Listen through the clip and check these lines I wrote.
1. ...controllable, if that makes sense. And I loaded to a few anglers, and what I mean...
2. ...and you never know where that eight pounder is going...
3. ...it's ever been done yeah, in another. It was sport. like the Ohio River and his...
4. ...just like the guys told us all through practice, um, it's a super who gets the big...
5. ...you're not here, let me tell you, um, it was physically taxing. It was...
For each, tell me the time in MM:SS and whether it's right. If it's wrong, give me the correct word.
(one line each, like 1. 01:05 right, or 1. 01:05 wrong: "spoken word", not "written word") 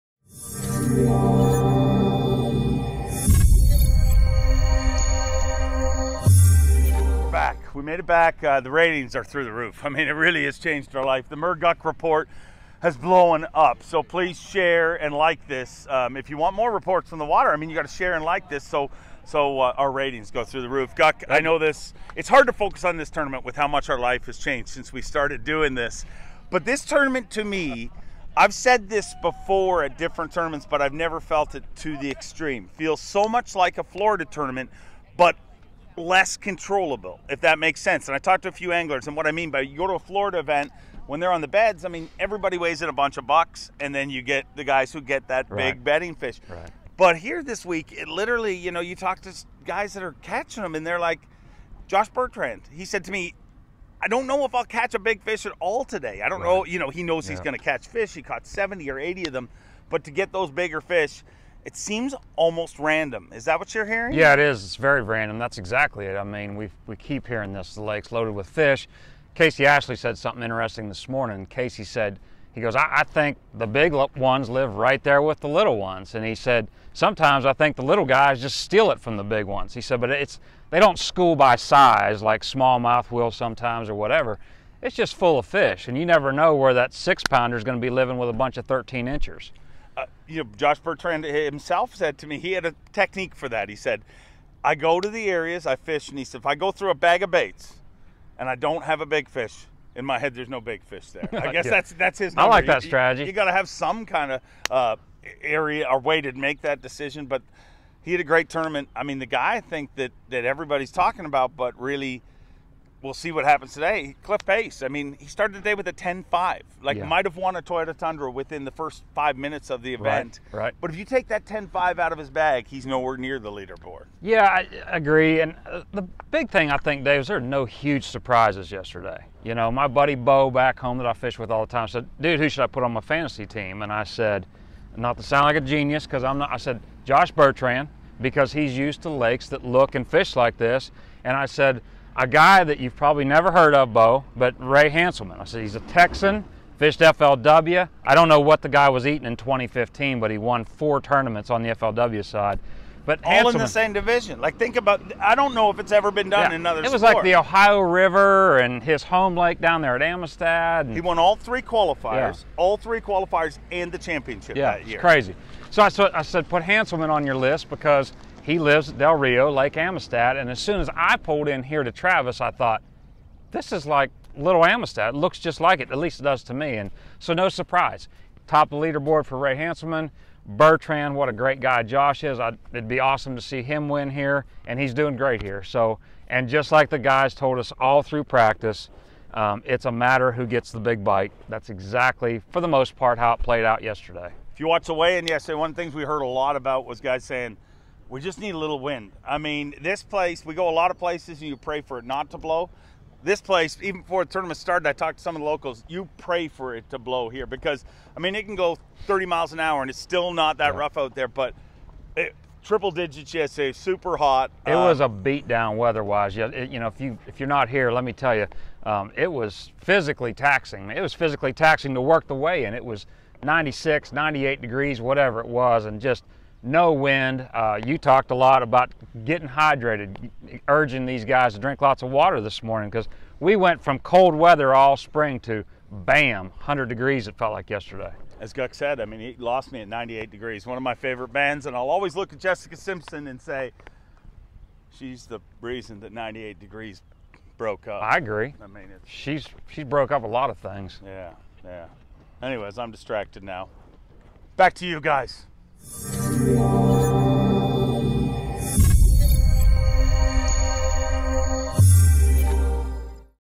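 1. 00:36 wrong: "talked", not "loaded"
2. 01:25 wrong: "six", not "eight"
3. 02:35 right
4. 03:06 wrong: "matter", not "super"
5. 03:37 right.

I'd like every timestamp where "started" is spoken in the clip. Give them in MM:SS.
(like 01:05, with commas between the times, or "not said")
00:25, 01:55, 03:24.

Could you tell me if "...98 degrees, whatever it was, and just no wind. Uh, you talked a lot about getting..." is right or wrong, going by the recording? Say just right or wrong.
right.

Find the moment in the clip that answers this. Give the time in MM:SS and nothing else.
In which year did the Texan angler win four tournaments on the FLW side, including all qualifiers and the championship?
02:29.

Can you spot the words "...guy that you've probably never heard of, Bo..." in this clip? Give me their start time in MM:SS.
02:22.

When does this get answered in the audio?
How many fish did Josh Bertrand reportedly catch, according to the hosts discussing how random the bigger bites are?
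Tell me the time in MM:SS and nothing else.
00:58.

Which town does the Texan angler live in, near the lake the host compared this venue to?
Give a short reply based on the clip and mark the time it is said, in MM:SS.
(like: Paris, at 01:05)
Del Rio, at 02:48.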